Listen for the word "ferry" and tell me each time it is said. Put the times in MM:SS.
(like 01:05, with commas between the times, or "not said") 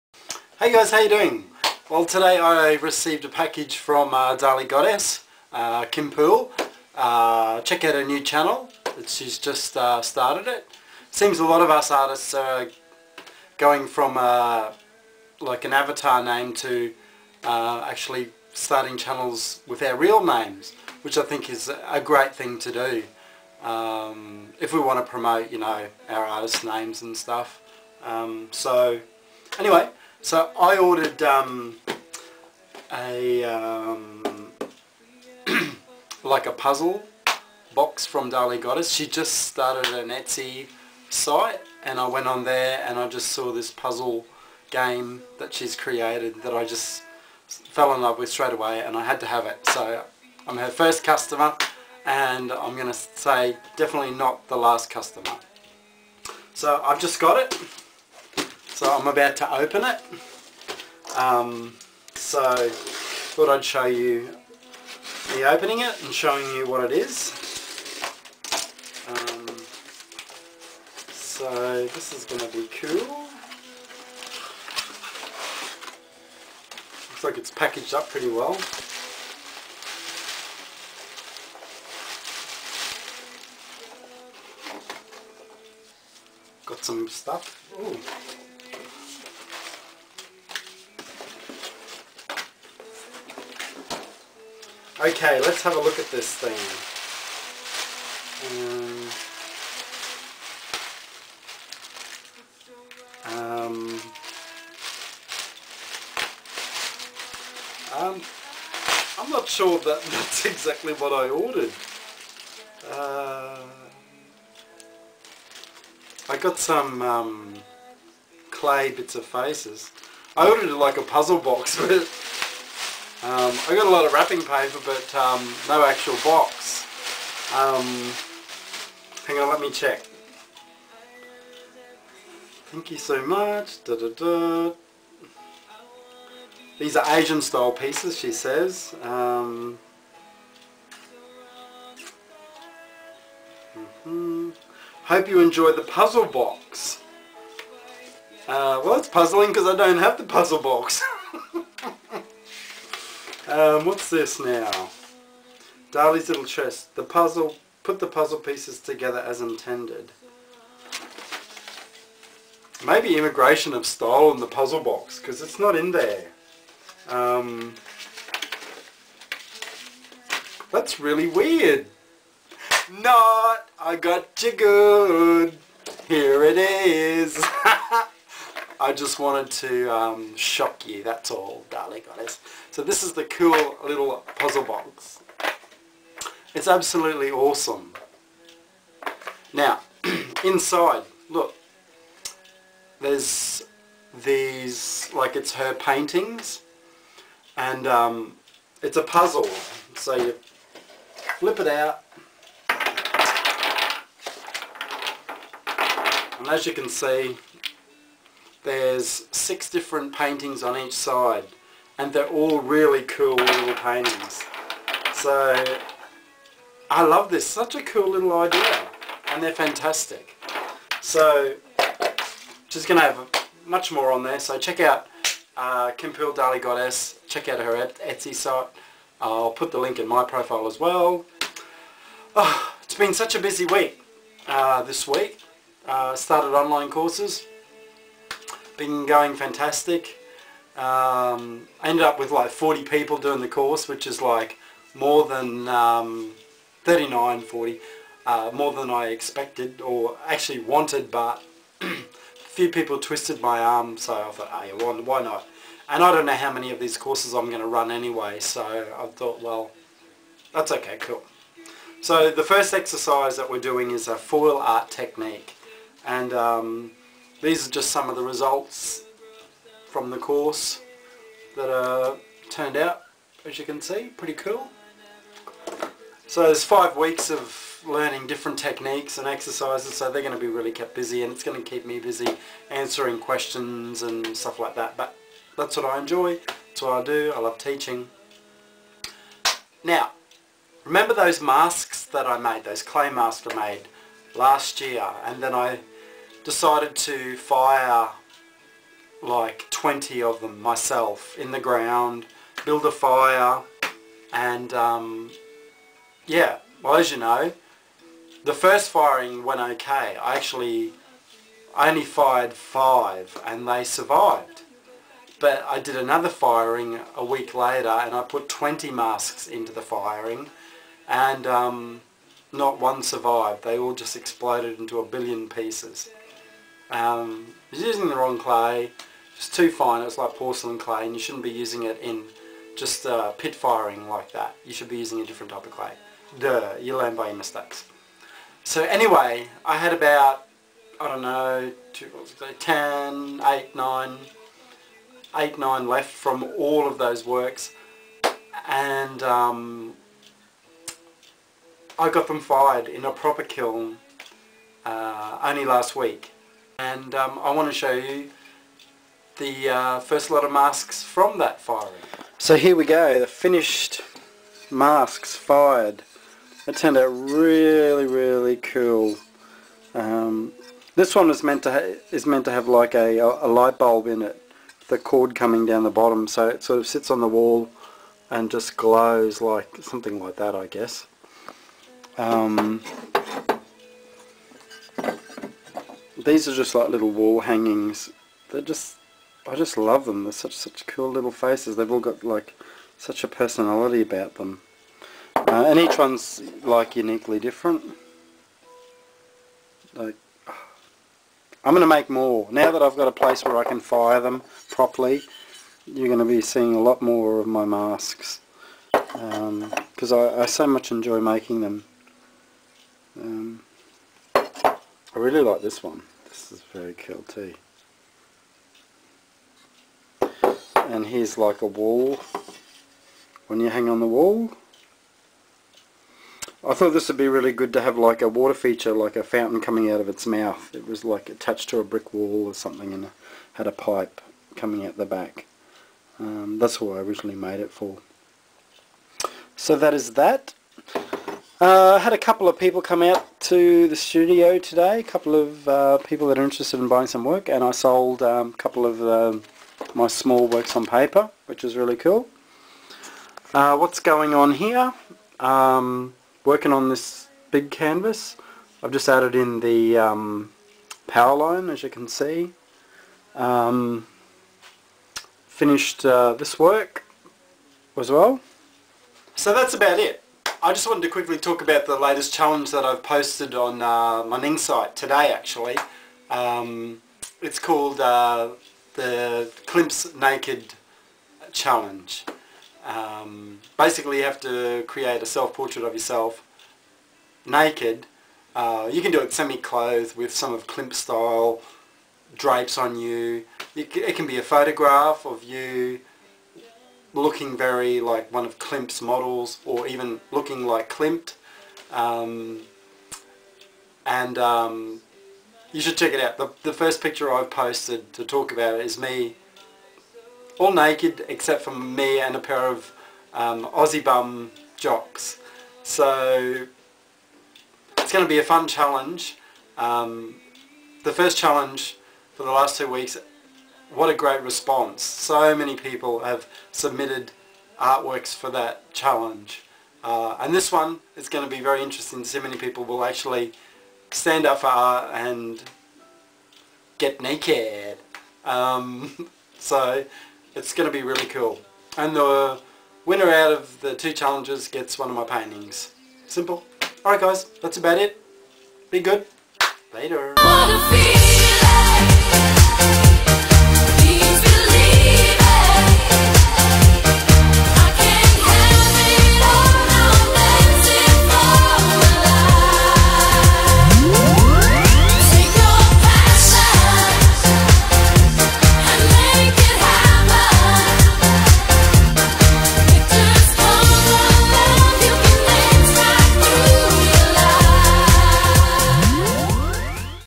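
not said.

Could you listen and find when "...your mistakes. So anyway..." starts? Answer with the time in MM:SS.
05:37.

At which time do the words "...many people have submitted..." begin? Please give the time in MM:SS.
08:45.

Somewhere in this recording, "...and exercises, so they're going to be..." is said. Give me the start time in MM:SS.
04:39.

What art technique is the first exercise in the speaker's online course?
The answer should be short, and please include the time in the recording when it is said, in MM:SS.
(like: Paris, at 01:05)
Foil art, at 04:24.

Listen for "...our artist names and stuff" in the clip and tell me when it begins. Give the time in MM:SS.
00:26.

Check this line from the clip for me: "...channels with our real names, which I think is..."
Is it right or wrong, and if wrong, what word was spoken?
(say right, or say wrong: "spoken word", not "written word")
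right.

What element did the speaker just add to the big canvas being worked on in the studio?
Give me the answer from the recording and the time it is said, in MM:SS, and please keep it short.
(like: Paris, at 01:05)
Power line, at 07:41.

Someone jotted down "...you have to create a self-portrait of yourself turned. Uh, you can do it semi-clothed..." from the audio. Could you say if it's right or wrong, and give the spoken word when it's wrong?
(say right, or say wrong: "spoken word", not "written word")
wrong: "naked", not "turned".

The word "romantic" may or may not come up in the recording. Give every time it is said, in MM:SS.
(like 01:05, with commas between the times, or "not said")
not said.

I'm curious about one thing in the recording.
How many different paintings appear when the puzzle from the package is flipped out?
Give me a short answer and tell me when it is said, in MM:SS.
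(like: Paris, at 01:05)
6, at 03:29.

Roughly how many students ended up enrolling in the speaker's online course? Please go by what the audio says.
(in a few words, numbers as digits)
40.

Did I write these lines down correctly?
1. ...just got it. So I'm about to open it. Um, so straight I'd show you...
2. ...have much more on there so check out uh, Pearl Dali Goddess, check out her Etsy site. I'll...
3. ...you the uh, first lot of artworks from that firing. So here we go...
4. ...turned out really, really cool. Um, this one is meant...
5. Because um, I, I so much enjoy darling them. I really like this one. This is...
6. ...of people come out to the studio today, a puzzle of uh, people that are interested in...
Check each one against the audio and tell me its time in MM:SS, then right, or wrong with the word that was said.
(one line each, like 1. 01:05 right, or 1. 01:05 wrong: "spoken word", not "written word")
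1. 00:57 wrong: "thought", not "straight"
2. 03:43 right
3. 05:57 wrong: "masks", not "artworks"
4. 06:06 right
5. 06:48 wrong: "making", not "darling"
6. 07:22 wrong: "couple", not "puzzle".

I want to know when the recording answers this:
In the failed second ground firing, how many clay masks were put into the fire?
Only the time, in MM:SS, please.
05:18.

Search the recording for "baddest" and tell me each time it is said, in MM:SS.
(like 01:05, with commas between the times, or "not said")
not said.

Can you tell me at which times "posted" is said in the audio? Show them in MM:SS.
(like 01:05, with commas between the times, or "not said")
07:53, 08:27.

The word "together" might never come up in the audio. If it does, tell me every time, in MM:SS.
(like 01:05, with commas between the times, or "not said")
02:38.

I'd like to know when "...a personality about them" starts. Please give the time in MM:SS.
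06:33.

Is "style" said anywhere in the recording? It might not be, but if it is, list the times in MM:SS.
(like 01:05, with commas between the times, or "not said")
02:17, 08:10.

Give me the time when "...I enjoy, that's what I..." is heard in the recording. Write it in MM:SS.
04:45.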